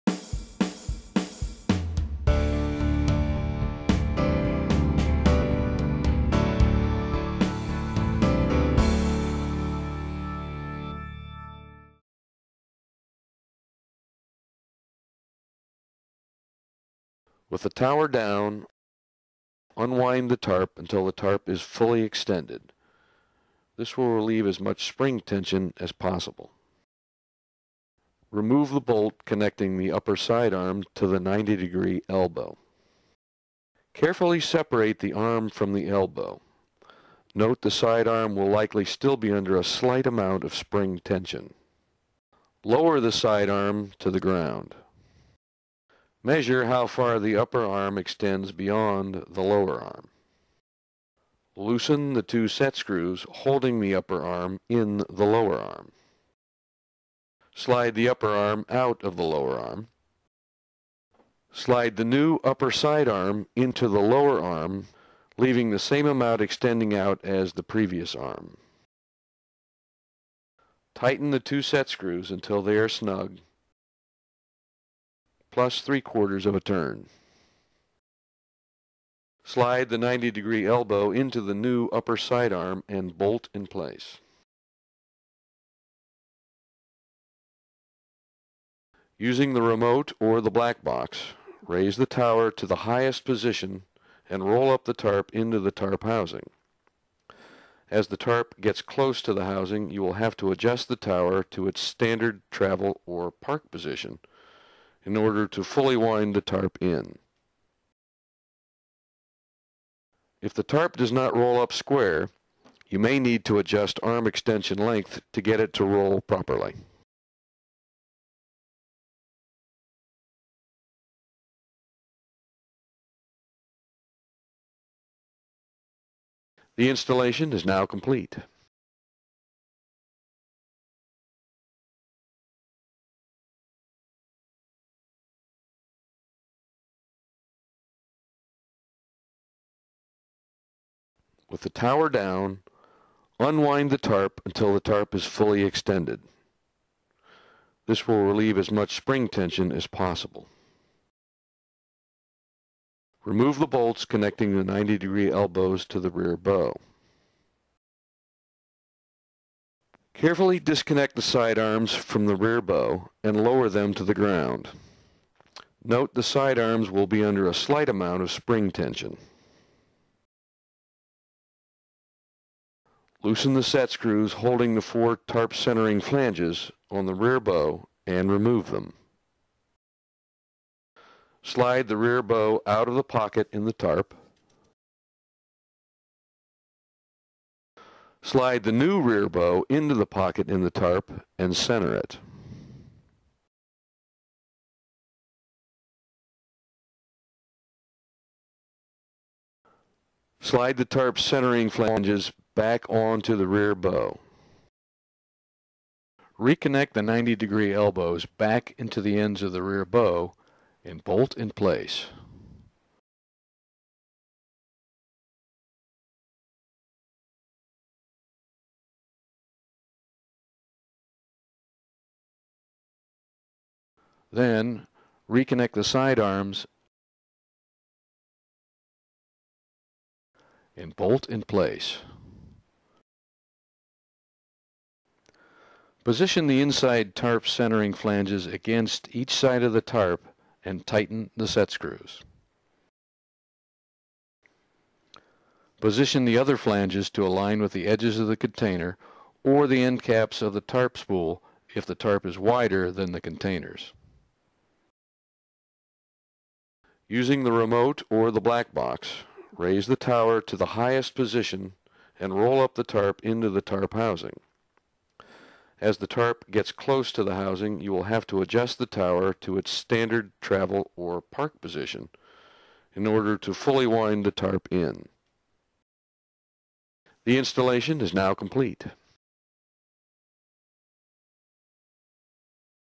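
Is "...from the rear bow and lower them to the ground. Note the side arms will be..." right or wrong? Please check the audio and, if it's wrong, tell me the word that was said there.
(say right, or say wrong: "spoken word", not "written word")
right.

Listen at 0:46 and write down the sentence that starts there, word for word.
Measure how far the upper arm extends beyond the lower arm.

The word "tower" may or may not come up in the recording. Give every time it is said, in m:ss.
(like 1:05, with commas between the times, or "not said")
0:17, 1:32, 1:40, 2:21, 4:19, 4:28.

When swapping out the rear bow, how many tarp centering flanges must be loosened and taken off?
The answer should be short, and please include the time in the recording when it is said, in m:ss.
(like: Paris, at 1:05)
4, at 2:54.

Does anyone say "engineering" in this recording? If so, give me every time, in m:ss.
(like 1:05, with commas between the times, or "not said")
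not said.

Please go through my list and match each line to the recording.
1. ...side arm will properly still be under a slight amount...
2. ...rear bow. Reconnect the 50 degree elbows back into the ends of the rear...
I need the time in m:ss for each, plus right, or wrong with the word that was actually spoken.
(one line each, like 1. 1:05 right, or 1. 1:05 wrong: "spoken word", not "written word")
1. 0:37 wrong: "likely", not "properly"
2. 3:23 wrong: "90", not "50".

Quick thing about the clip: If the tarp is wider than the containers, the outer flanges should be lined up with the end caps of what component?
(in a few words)
tarp spool.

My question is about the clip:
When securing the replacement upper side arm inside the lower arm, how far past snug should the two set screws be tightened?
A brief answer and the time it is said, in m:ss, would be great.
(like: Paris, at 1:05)
3/4 of a turn, at 1:15.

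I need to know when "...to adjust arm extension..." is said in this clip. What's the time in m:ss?
1:53.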